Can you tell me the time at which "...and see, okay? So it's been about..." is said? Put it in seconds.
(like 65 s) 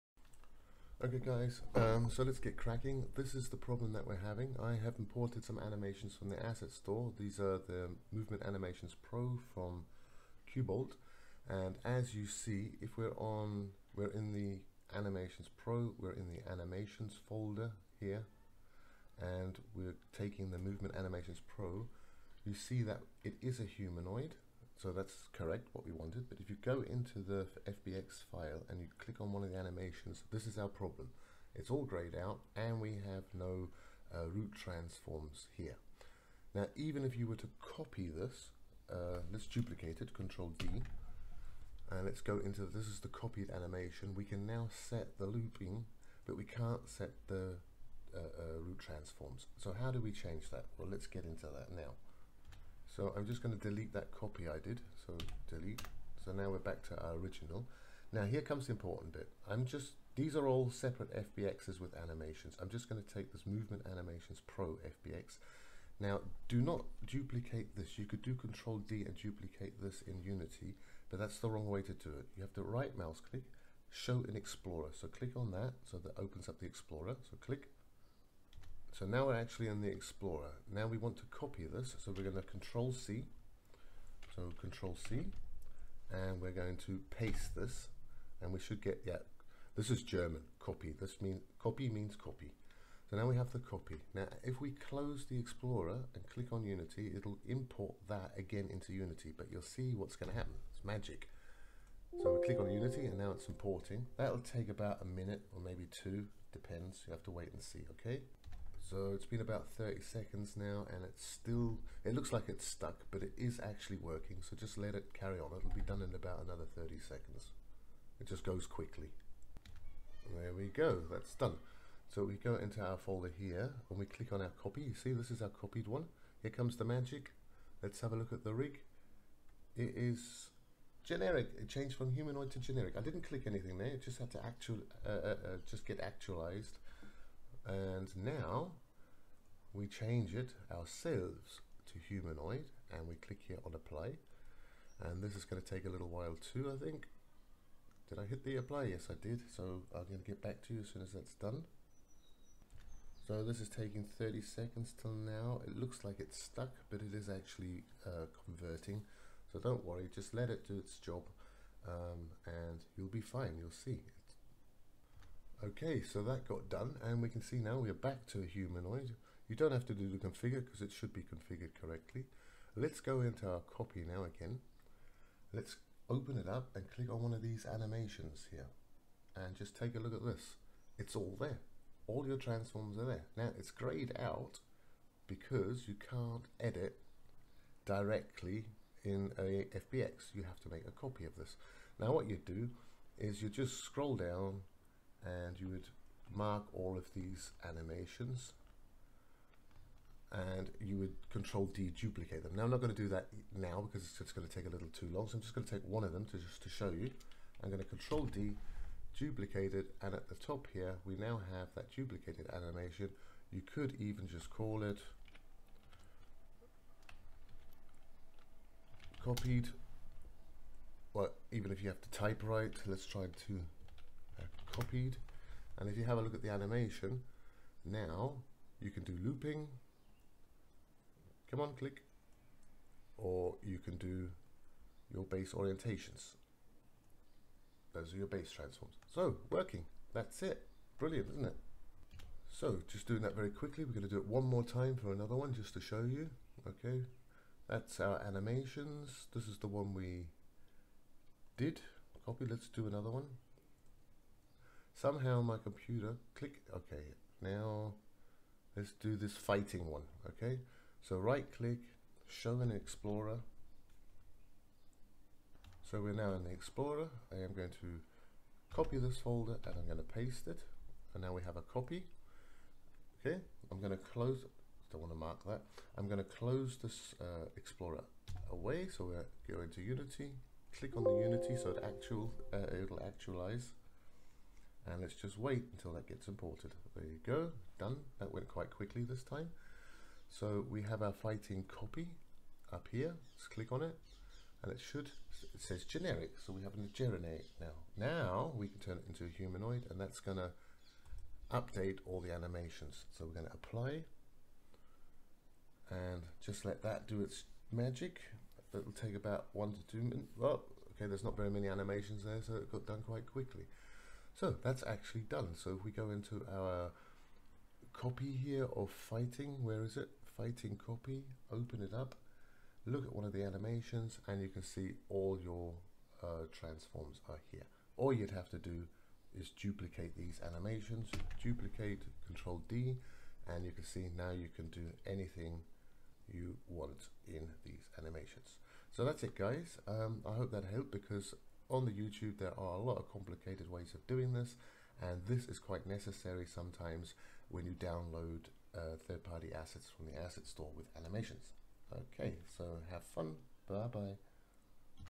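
107 s.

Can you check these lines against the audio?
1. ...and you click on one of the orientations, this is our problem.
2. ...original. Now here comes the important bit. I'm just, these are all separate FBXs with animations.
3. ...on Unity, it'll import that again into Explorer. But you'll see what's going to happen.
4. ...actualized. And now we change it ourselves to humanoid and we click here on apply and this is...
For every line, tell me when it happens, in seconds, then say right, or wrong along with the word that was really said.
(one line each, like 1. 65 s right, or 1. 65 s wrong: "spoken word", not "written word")
1. 28 s wrong: "animations", not "orientations"
2. 57 s right
3. 96 s wrong: "Unity", not "Explorer"
4. 136 s right.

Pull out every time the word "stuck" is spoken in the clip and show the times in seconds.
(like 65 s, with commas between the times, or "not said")
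112 s, 156 s.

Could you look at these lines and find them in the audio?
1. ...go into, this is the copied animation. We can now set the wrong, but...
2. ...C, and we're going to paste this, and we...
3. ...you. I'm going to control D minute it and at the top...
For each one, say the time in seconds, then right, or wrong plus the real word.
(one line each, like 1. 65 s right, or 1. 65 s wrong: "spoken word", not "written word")
1. 42 s wrong: "looping", not "wrong"
2. 85 s right
3. 206 s wrong: "duplicate", not "minute".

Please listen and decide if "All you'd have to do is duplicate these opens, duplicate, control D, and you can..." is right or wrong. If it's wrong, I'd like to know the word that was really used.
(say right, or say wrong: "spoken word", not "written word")
wrong: "animations", not "opens".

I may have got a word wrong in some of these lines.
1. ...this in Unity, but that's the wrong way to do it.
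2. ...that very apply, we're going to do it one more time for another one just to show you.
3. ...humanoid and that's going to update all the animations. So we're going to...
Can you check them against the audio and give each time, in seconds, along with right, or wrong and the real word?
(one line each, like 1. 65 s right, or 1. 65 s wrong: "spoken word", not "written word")
1. 69 s right
2. 243 s wrong: "quickly", not "apply"
3. 299 s right.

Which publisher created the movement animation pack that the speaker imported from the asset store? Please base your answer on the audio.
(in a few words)
Kubold.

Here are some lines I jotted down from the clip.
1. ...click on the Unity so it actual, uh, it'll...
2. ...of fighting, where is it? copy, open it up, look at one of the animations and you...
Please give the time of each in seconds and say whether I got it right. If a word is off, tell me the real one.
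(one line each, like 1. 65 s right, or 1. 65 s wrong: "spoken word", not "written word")
1. 280 s right
2. 318 s right.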